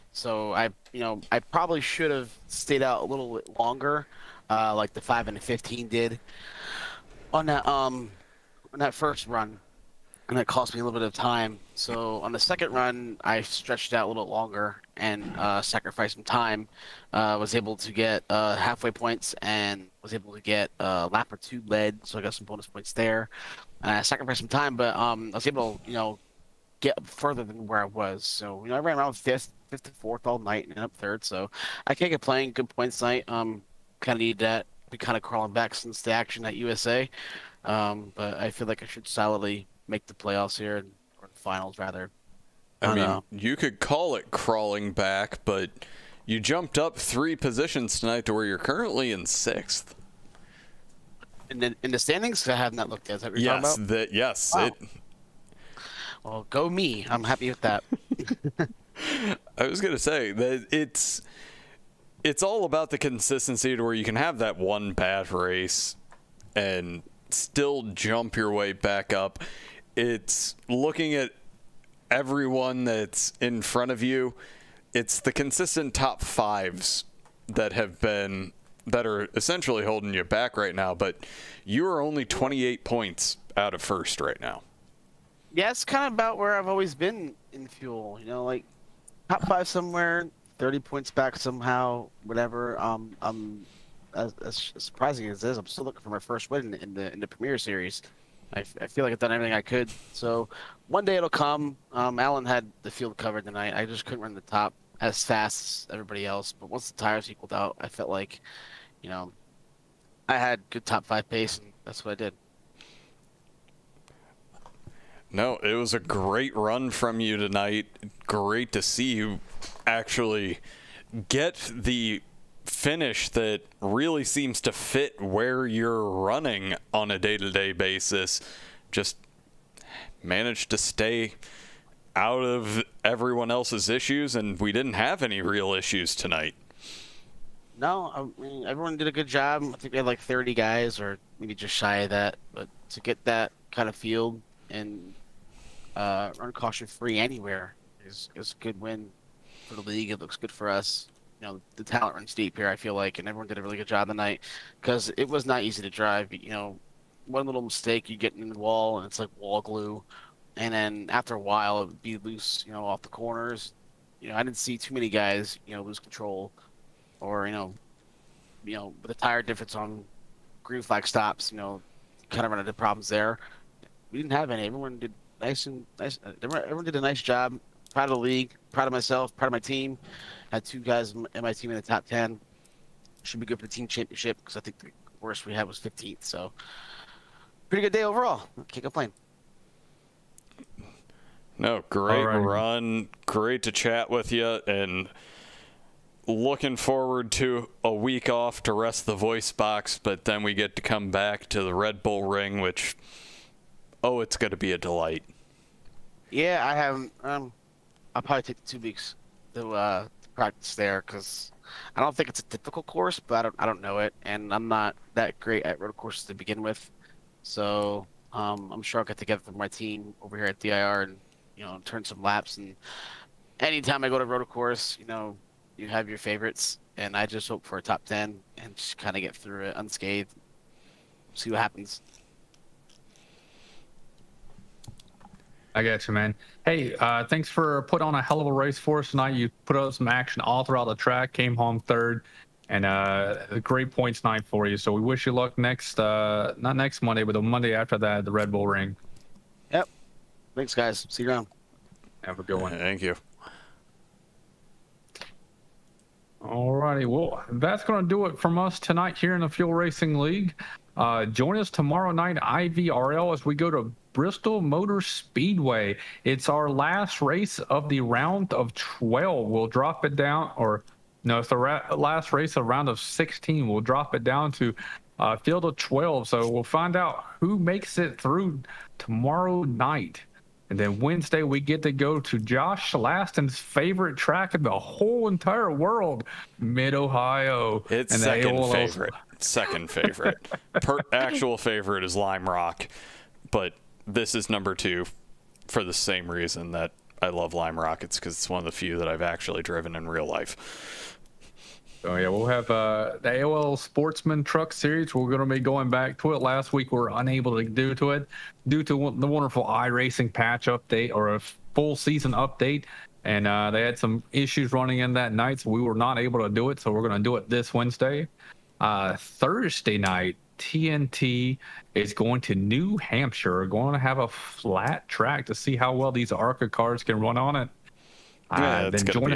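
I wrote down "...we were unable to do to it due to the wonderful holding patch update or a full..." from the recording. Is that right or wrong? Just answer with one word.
wrong.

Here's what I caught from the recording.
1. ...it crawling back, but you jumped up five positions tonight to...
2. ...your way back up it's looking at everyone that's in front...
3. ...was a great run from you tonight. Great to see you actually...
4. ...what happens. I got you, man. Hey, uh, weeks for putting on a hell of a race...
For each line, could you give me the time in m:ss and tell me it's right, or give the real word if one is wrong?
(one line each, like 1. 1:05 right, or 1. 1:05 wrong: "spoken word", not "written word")
1. 0:44 wrong: "three", not "five"
2. 1:08 right
3. 1:55 right
4. 3:51 wrong: "thanks", not "weeks".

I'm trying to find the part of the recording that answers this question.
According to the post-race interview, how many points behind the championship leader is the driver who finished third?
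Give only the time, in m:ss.
1:22.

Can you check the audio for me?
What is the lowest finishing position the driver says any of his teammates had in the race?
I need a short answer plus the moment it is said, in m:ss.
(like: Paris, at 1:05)
15th, at 3:05.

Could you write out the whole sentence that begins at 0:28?
So you know, I ran around fifth, fifth to fourth all night and up third.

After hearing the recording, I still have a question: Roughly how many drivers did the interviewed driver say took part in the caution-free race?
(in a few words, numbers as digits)
30.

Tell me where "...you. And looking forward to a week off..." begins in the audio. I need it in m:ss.
3:14.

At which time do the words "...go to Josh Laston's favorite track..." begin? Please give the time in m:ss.
4:41.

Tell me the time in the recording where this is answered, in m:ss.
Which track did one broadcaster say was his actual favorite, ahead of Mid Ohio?
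4:52.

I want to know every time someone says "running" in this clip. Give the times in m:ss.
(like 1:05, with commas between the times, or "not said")
2:06, 5:14.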